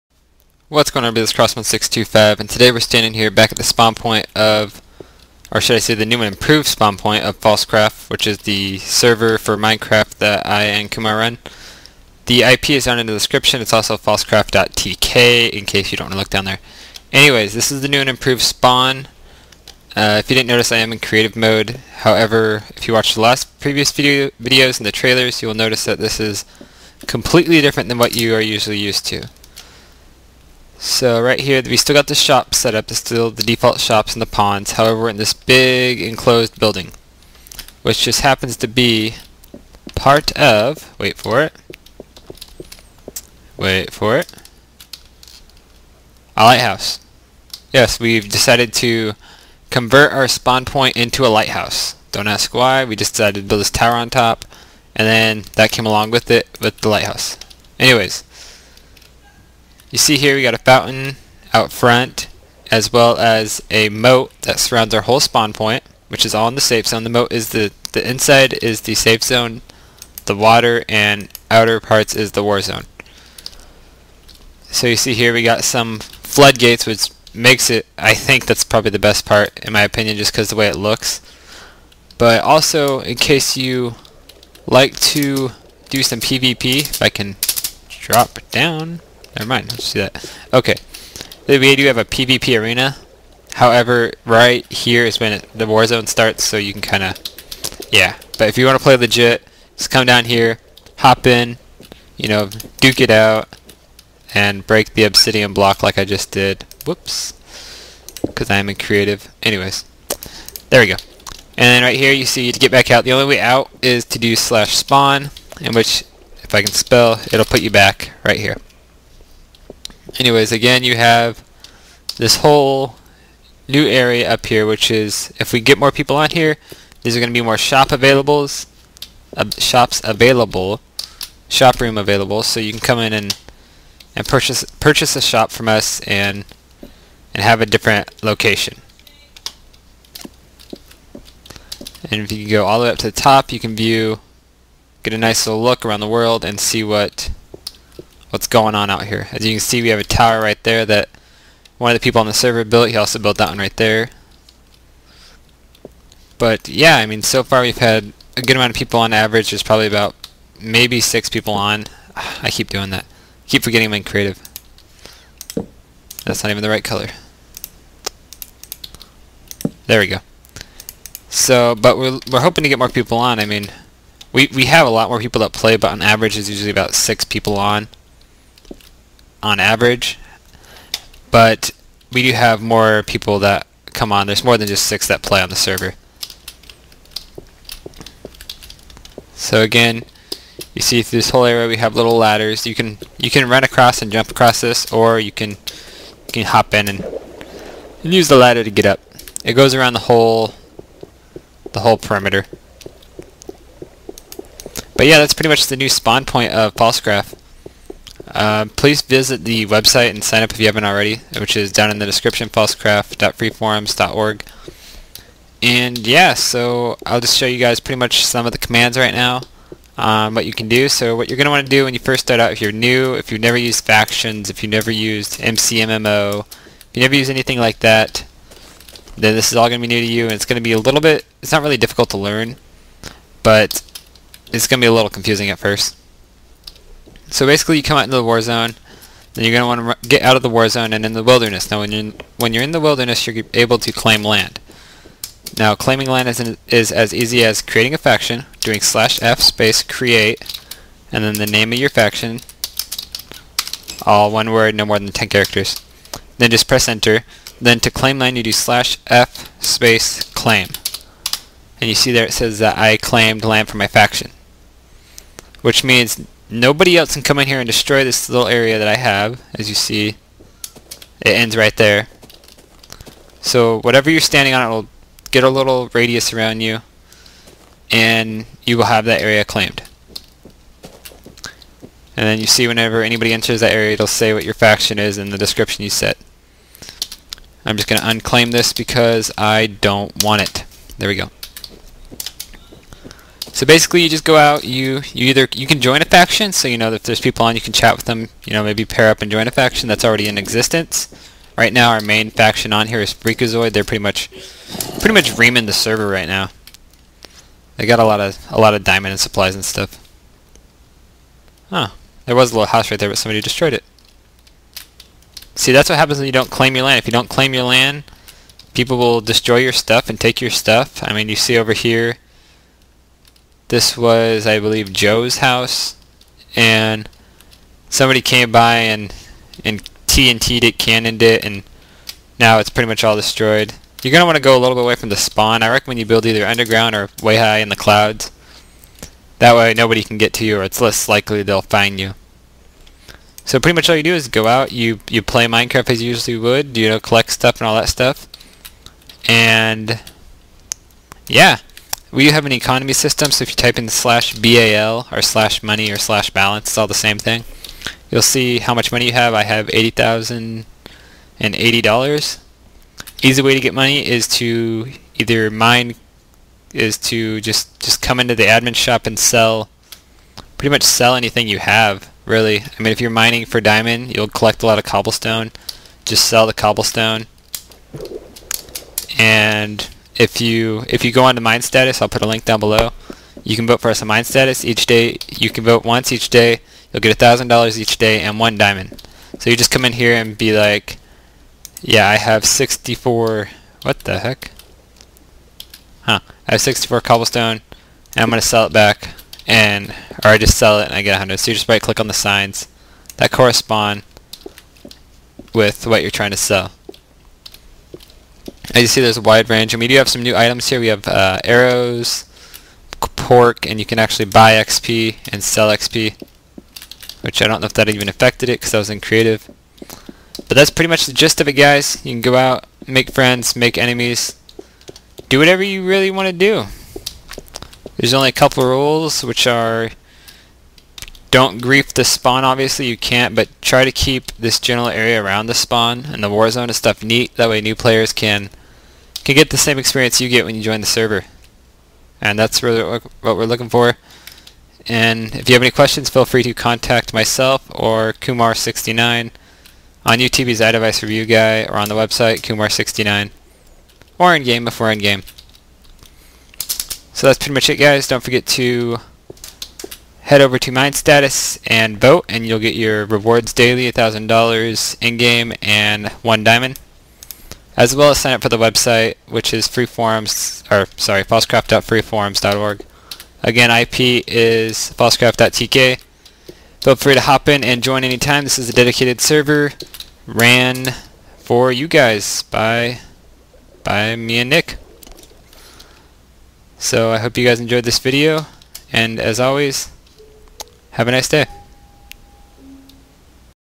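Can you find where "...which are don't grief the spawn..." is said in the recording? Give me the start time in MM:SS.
07:09.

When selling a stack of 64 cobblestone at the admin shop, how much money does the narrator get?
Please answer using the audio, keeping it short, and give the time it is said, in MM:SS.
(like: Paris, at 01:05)
100, at 06:41.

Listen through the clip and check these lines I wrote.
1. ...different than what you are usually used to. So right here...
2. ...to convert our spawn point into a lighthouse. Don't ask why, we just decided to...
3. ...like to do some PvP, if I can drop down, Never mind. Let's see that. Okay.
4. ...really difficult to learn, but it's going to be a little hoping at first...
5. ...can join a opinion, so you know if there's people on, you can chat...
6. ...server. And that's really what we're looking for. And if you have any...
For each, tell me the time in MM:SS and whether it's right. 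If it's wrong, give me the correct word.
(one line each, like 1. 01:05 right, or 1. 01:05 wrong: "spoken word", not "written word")
1. 00:27 right
2. 00:48 right
3. 01:24 right
4. 03:51 wrong: "confusing", not "hoping"
5. 04:55 wrong: "faction", not "opinion"
6. 07:20 right.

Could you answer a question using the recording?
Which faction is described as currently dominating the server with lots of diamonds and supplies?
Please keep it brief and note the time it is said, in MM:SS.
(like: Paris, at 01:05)
Freakazoid, at 05:03.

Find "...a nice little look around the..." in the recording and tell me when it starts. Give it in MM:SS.
02:25.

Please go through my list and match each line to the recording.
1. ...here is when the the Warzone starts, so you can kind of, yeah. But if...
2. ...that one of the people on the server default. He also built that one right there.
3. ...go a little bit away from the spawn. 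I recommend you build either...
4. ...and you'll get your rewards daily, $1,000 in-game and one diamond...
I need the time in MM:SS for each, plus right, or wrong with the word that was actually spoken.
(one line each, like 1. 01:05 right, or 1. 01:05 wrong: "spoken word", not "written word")
1. 01:34 right
2. 02:30 wrong: "built", not "default"
3. 05:34 right
4. 07:42 right.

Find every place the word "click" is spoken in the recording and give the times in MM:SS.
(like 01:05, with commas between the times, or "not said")
06:41.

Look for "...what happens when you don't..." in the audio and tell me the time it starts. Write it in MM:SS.
05:15.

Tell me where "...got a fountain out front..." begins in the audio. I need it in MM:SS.
01:00.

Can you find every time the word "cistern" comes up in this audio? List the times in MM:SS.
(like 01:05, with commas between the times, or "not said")
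not said.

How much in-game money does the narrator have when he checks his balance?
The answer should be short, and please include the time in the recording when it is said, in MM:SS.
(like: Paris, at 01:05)
$80,080, at 05:59.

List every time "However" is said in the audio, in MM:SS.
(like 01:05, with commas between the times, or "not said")
00:21, 00:34, 01:33.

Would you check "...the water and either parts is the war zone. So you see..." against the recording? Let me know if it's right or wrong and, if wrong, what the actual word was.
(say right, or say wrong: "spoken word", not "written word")
wrong: "outer", not "either".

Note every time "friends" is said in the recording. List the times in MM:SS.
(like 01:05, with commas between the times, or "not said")
07:03.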